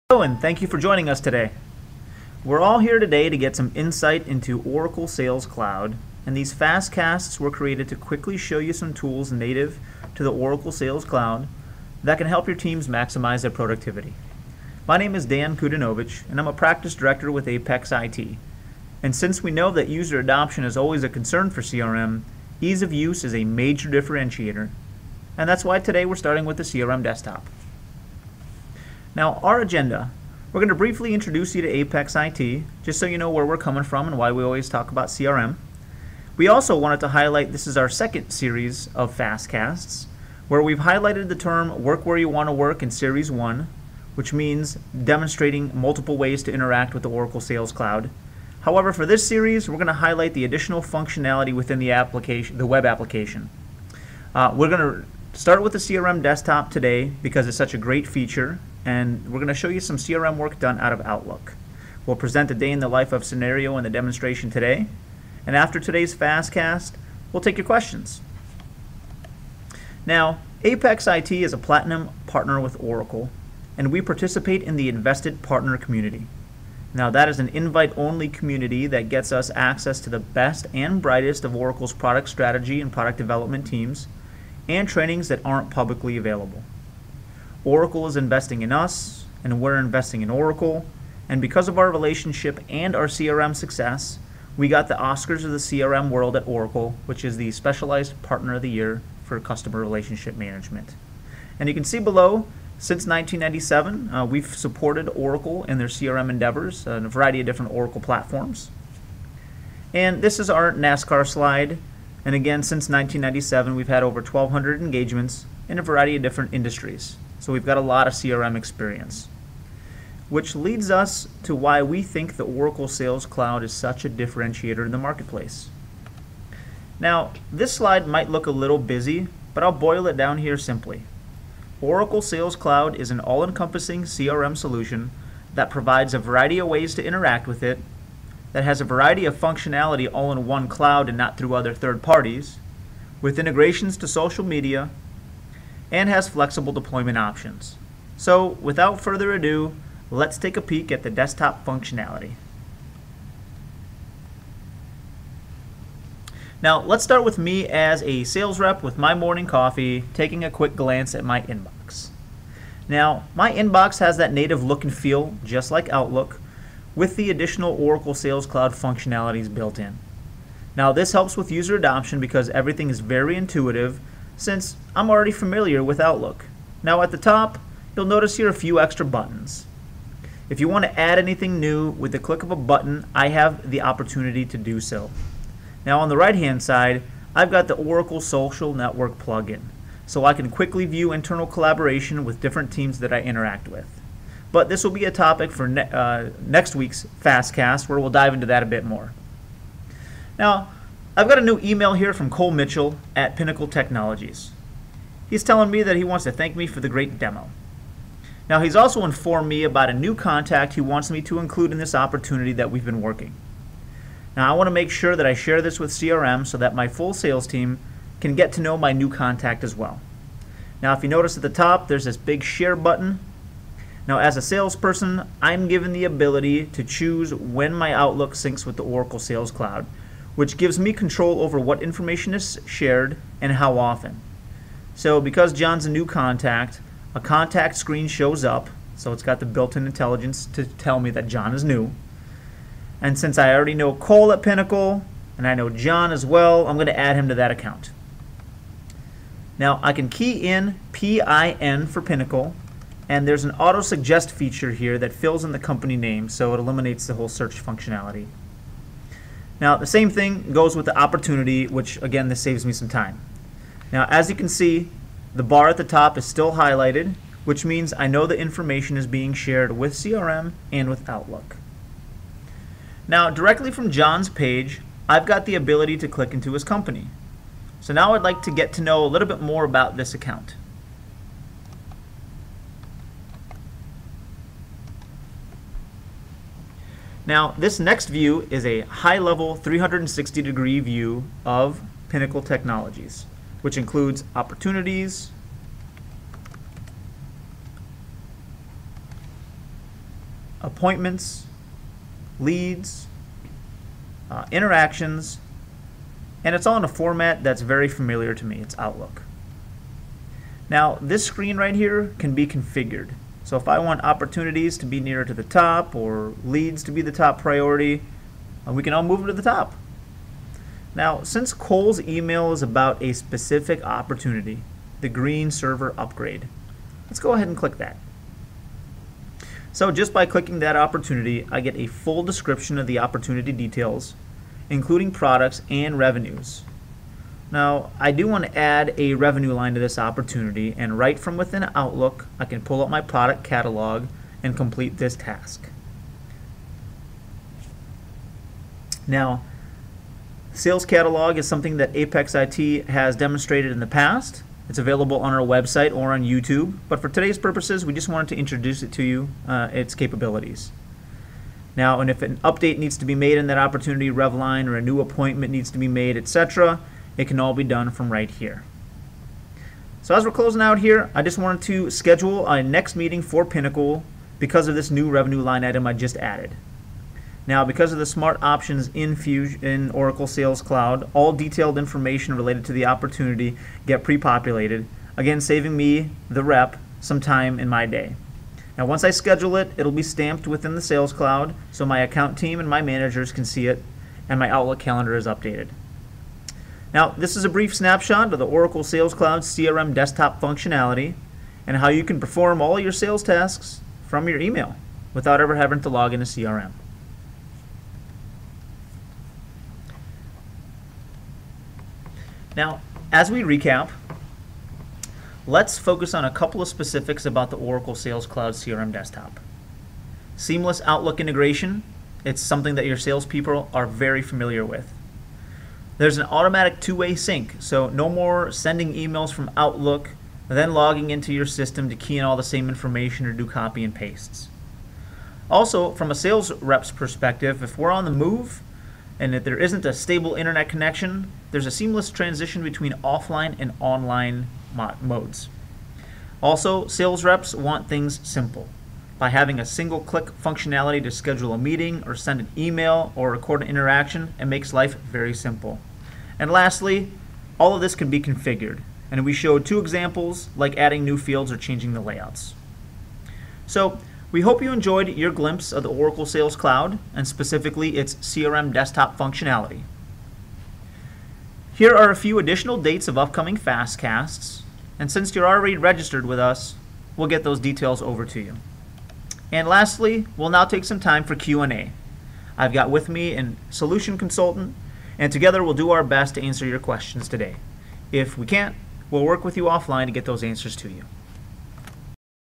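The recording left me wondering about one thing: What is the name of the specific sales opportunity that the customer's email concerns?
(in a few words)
green server upgrade.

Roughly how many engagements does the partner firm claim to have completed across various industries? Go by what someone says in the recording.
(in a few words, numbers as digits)
1,200.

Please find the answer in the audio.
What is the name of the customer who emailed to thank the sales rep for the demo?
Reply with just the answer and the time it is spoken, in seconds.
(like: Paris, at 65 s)
Cole Mitchell, at 202 s.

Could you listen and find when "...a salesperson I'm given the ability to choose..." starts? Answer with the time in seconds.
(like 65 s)
224 s.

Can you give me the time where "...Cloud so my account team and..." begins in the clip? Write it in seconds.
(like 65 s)
391 s.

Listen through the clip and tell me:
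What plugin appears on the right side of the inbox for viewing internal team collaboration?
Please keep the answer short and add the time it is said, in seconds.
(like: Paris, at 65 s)
Oracle Social Network, at 187 s.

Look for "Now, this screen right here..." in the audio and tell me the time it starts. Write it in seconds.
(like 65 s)
310 s.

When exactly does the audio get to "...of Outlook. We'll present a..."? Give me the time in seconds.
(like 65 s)
60 s.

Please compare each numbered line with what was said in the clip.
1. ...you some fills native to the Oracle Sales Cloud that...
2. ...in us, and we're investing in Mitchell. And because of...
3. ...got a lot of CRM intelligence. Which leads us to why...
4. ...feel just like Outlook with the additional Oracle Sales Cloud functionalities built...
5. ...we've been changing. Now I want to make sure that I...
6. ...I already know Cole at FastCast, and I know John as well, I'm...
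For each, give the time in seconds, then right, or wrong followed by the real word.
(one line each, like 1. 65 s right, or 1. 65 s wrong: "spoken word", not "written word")
1. 8 s wrong: "tools", not "fills"
2. 88 s wrong: "Oracle", not "Mitchell"
3. 117 s wrong: "experience", not "intelligence"
4. 164 s right
5. 212 s wrong: "working", not "changing"
6. 243 s wrong: "Pinnacle", not "FastCast".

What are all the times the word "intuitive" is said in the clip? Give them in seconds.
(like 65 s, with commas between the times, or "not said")
173 s.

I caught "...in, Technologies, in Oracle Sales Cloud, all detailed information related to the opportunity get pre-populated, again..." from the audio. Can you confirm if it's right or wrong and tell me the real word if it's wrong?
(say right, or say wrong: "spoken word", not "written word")
wrong: "Fusion", not "Technologies".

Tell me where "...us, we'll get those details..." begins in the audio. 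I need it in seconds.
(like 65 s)
476 s.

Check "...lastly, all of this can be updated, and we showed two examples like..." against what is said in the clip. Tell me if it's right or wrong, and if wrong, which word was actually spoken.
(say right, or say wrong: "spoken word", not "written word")
wrong: "configured", not "updated".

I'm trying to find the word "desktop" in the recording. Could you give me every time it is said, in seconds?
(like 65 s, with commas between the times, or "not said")
27 s, 56 s, 151 s, 399 s, 418 s, 468 s.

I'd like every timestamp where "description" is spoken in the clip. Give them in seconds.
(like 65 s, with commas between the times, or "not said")
332 s.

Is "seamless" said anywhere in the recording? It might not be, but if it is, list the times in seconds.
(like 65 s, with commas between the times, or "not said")
420 s, 441 s.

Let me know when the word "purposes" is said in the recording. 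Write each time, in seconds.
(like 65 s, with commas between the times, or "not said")
357 s.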